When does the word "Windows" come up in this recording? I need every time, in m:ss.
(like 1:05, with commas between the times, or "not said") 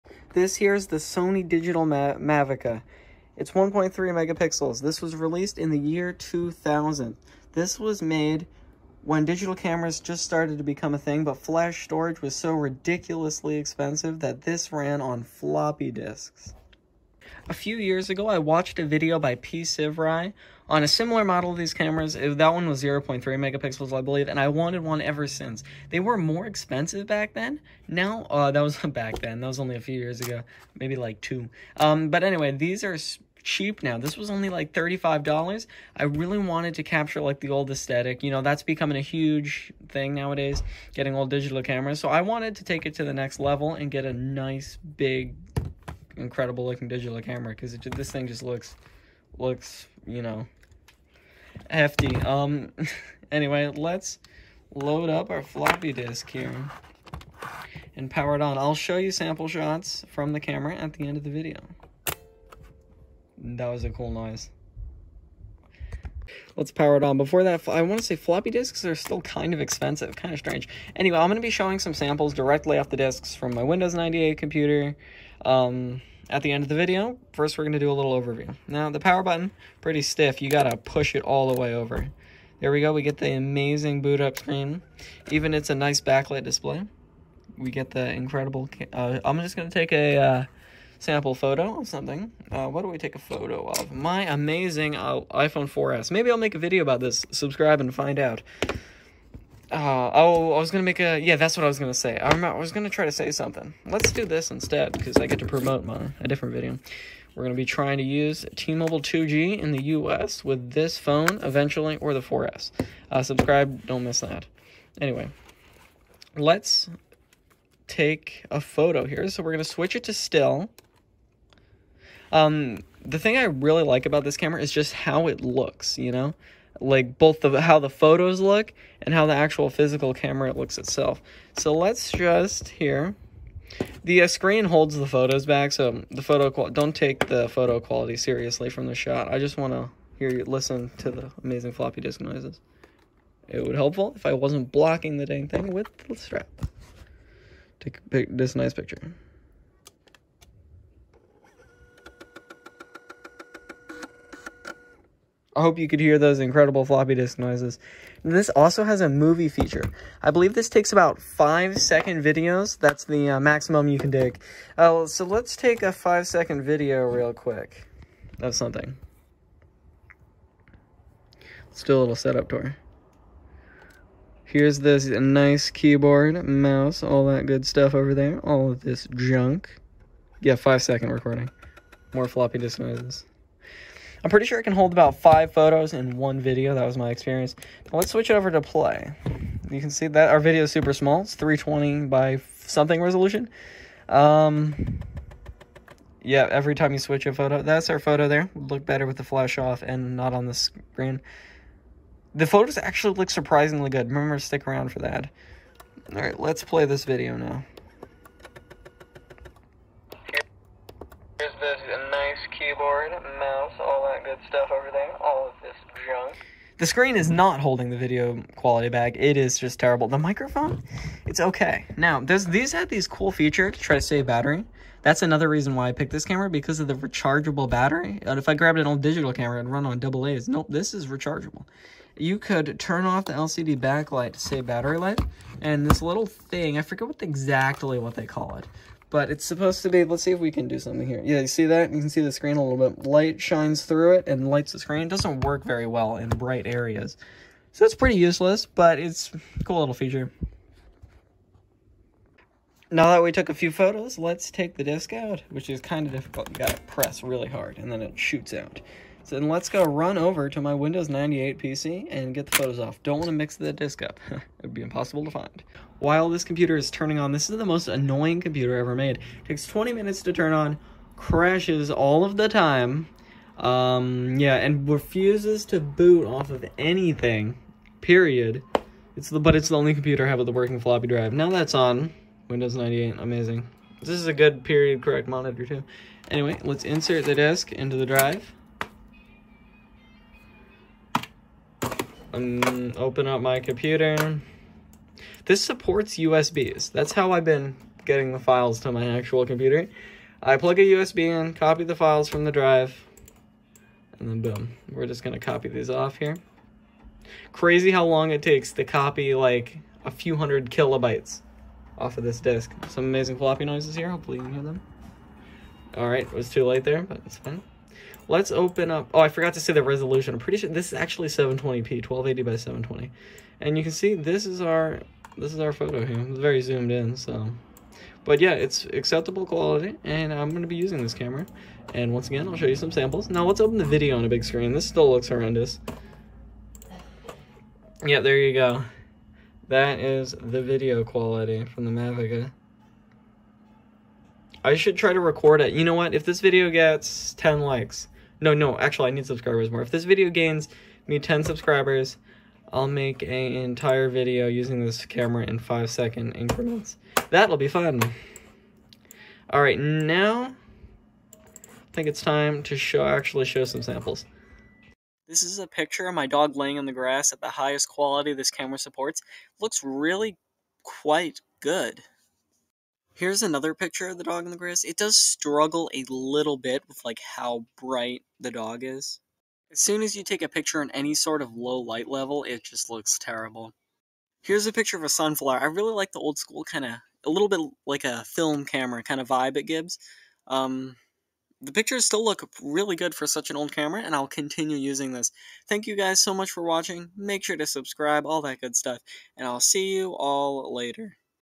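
1:13, 4:20, 4:42.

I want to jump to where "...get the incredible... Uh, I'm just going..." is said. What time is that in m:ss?
1:27.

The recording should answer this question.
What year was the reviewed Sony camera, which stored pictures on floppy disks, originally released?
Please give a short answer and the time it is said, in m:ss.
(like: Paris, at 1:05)
2000, at 0:06.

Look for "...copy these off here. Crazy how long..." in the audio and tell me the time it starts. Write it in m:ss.
5:05.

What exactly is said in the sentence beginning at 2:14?
The uh, screen holds the photos back, so the photo don't take the photo quality seriously from the shot.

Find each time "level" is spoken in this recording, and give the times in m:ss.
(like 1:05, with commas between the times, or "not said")
0:43, 6:22.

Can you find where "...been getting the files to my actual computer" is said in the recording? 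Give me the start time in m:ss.
4:57.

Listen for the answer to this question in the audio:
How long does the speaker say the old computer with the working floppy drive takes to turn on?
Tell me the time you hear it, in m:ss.
4:29.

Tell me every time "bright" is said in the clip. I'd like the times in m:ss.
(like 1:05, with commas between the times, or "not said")
4:06, 6:17.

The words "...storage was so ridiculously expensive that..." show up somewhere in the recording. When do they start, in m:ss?
0:11.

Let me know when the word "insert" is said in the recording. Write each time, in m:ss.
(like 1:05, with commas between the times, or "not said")
4:46.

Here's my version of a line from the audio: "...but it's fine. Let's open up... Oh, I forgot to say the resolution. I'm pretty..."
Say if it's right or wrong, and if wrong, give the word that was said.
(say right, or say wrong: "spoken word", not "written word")
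right.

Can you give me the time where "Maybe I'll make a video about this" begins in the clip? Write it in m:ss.
1:36.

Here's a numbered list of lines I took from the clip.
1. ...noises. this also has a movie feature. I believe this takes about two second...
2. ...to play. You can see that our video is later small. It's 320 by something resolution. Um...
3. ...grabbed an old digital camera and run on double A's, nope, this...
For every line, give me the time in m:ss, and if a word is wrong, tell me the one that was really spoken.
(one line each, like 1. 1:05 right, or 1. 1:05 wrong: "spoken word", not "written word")
1. 2:37 wrong: "five", not "two"
2. 3:08 wrong: "super", not "later"
3. 3:48 right.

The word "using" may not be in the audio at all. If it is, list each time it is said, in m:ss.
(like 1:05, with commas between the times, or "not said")
5:30, 5:54, 6:34.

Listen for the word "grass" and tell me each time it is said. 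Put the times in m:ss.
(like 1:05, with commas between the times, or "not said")
6:06, 6:14.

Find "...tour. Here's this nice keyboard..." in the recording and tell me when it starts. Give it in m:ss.
2:52.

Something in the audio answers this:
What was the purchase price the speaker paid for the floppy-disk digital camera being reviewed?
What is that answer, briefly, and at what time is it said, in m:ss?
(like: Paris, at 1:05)
$35, at 0:34.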